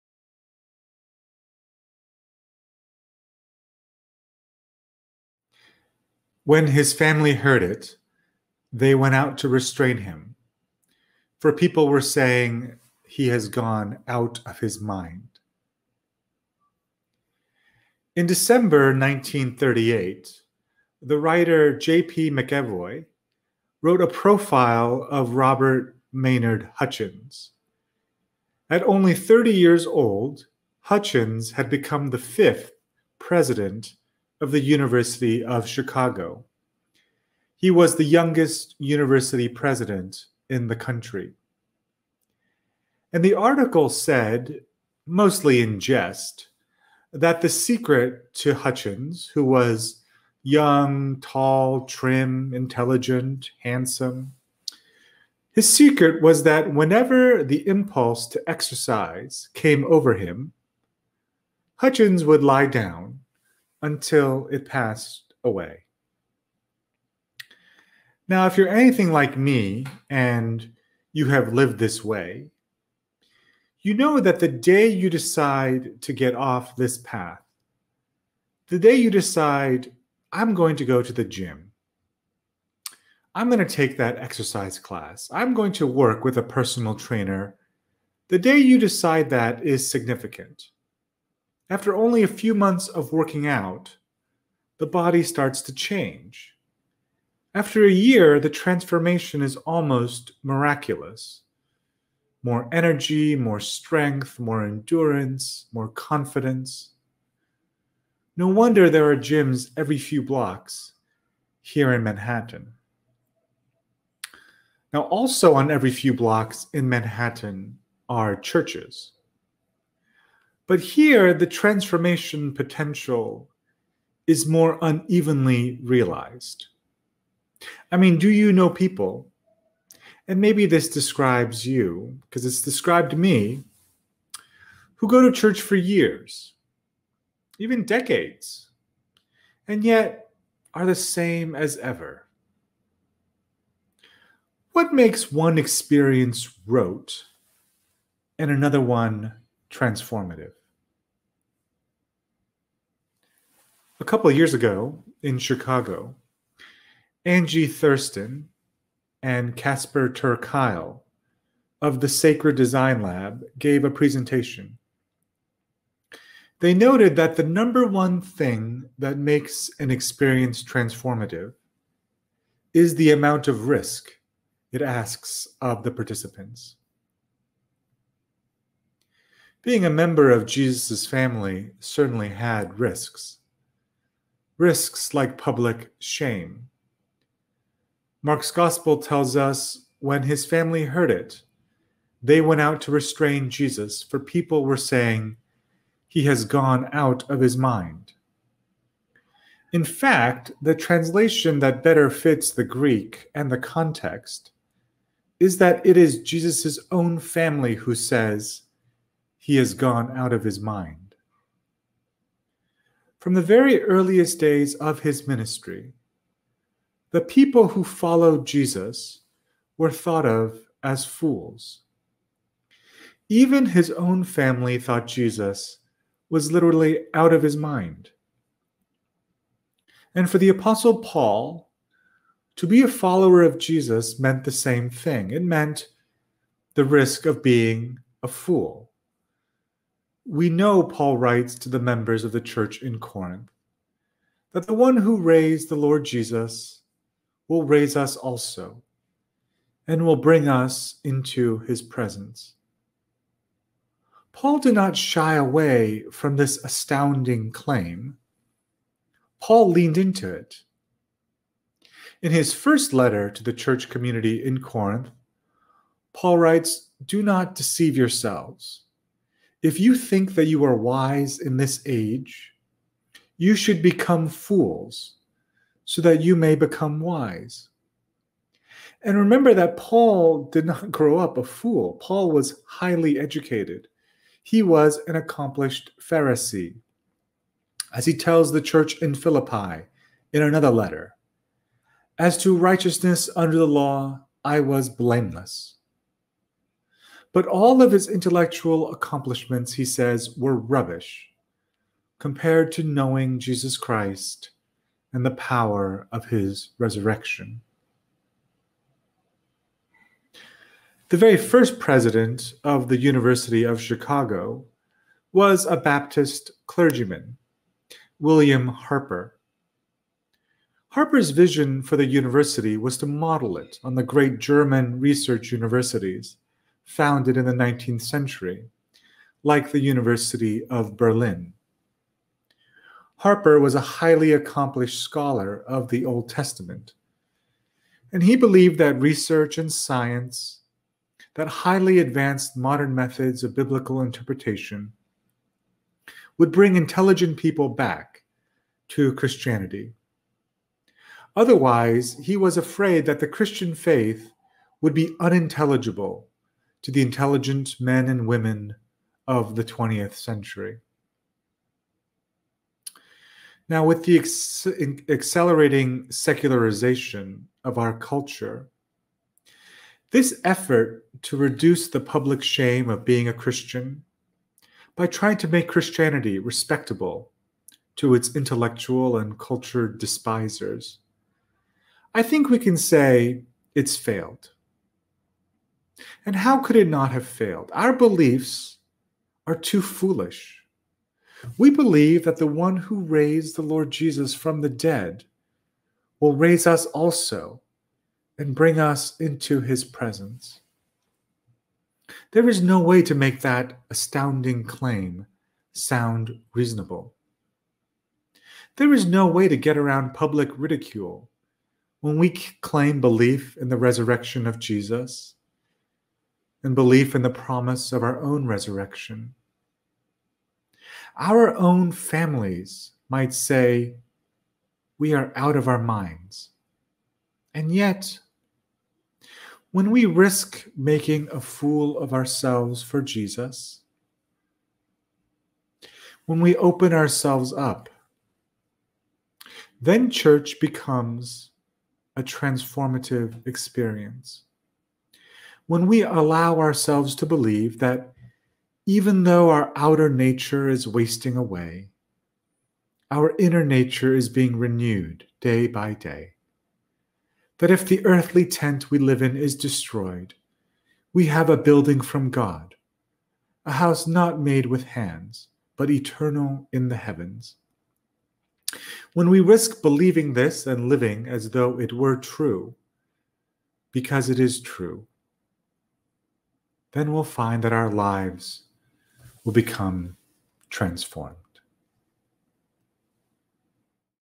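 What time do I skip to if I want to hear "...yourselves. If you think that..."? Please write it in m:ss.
4:27.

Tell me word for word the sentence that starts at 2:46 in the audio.
They noted that the number one thing that makes an experience transformative is the amount of risk it asks of the participants.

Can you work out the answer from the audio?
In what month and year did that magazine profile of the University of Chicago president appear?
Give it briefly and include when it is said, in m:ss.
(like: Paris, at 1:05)
December 1938, at 0:18.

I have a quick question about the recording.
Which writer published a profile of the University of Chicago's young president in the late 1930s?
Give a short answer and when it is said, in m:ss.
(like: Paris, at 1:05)
J.P. McEvoy, at 0:21.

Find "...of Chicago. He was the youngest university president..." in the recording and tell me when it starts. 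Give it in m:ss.
0:35.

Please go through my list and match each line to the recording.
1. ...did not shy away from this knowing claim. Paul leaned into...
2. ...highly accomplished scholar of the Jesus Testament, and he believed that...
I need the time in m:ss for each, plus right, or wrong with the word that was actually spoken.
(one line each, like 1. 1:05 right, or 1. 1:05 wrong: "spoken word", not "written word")
1. 4:14 wrong: "astounding", not "knowing"
2. 5:33 wrong: "Old", not "Jesus".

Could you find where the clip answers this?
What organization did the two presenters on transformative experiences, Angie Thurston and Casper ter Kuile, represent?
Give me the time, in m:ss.
2:42.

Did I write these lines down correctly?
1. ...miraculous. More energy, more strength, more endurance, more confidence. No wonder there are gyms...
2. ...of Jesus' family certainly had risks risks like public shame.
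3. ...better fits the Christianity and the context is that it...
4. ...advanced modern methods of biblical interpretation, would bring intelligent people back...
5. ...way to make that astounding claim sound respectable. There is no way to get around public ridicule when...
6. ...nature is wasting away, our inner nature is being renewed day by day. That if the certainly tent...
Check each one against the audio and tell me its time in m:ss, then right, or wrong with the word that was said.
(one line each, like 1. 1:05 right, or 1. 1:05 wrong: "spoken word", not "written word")
1. 1:40 right
2. 3:00 right
3. 3:21 wrong: "Greek", not "Christianity"
4. 5:41 right
5. 6:42 wrong: "reasonable", not "respectable"
6. 7:30 wrong: "earthly", not "certainly".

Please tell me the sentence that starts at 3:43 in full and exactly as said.
Even his own family thought Jesus was literally out of his mind.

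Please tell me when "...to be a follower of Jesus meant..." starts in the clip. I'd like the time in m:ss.
3:52.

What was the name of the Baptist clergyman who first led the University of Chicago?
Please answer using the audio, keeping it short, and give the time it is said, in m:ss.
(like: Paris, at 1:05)
William Harper, at 5:18.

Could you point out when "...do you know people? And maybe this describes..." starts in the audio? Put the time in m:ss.
2:08.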